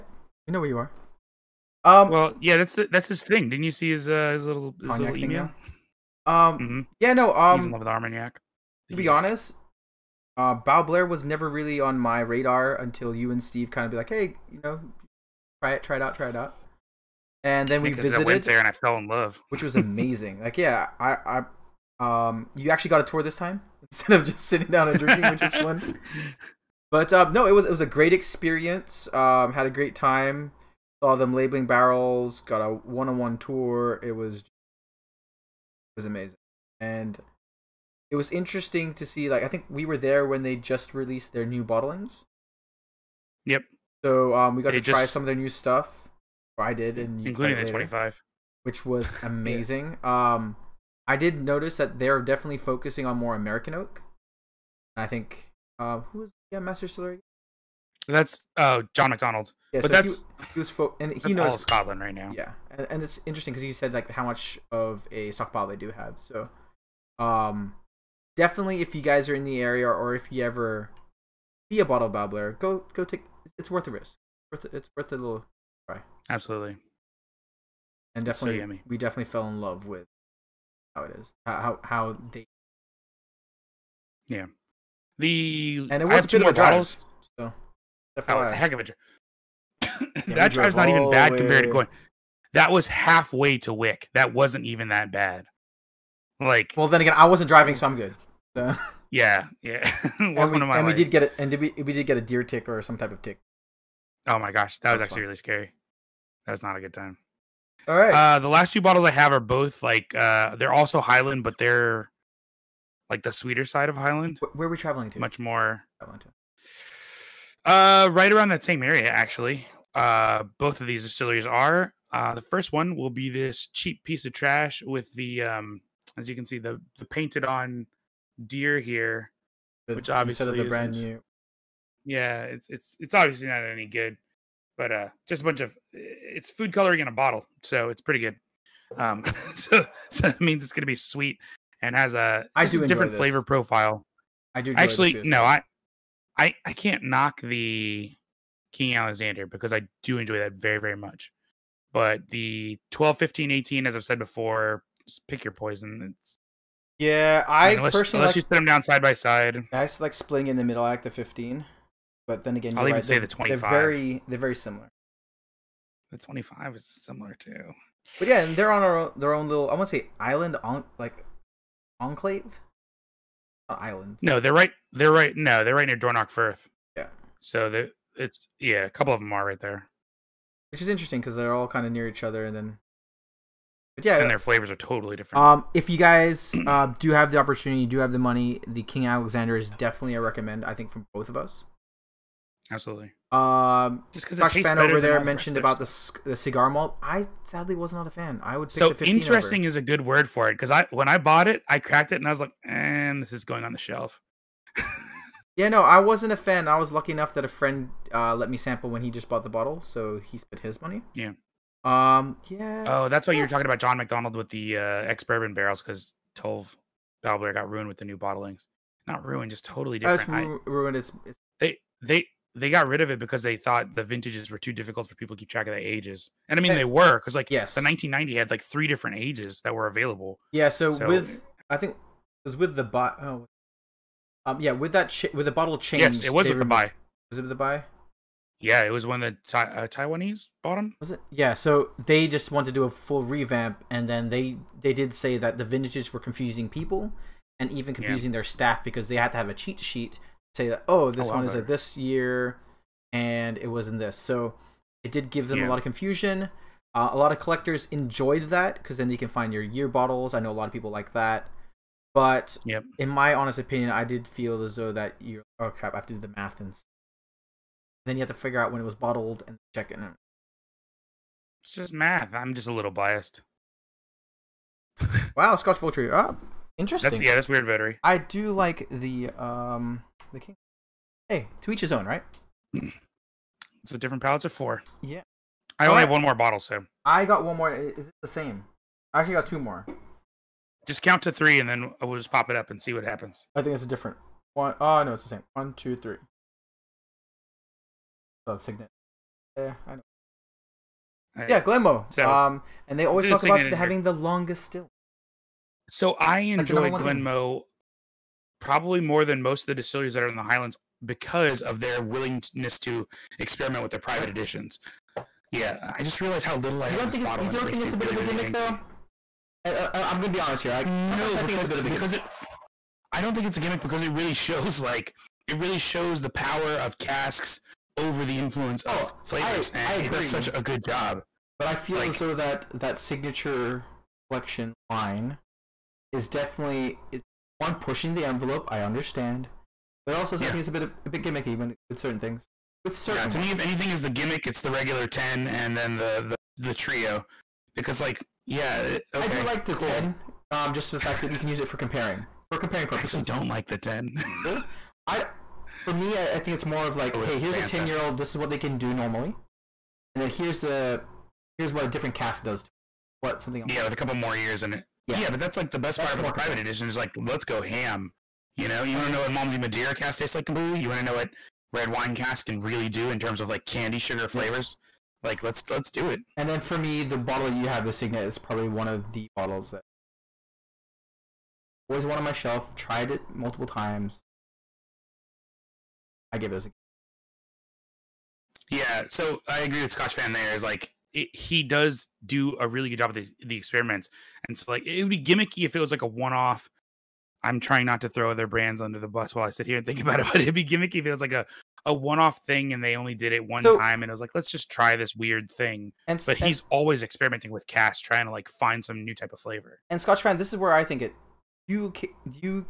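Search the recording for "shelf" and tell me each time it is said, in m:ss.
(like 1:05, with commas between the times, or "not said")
3:23, 6:22.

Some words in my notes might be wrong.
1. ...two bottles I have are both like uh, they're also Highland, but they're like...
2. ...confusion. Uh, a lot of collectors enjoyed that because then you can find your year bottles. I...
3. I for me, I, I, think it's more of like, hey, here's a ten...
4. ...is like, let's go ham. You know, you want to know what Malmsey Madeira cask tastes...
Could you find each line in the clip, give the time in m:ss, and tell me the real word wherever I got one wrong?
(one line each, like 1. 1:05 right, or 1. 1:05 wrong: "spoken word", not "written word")
1. 1:48 right
2. 4:15 right
3. 5:55 right
4. 6:06 right.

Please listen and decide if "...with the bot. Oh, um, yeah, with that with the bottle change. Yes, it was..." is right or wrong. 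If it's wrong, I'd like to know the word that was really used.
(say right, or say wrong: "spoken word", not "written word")
right.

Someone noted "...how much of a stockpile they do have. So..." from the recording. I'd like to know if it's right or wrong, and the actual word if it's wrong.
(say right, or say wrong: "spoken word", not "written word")
right.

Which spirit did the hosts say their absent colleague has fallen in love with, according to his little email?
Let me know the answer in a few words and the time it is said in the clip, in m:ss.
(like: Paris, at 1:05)
Armagnac, at 0:07.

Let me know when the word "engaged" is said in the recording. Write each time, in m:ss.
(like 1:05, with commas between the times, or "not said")
not said.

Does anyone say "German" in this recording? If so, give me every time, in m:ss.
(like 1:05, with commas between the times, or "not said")
not said.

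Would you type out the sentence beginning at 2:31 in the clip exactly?
But the 12, 15, 18, as I've said before, pick your poison.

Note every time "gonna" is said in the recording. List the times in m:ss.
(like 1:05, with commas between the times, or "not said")
2:20, 5:20.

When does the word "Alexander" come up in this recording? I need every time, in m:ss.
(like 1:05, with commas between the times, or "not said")
2:28, 3:09.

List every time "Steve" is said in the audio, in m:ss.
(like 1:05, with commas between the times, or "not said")
0:13.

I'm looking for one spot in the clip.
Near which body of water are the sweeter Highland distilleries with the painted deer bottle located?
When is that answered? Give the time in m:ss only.
2:55.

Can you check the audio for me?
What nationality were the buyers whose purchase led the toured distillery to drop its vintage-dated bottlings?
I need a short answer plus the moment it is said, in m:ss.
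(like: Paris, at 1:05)
Taiwanese, at 3:59.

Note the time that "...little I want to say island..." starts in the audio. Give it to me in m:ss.
2:49.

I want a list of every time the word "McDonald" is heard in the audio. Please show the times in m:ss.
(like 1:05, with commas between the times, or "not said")
0:59, 3:33.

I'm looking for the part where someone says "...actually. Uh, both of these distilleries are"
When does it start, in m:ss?
1:59.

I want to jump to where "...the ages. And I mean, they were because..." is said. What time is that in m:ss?
3:45.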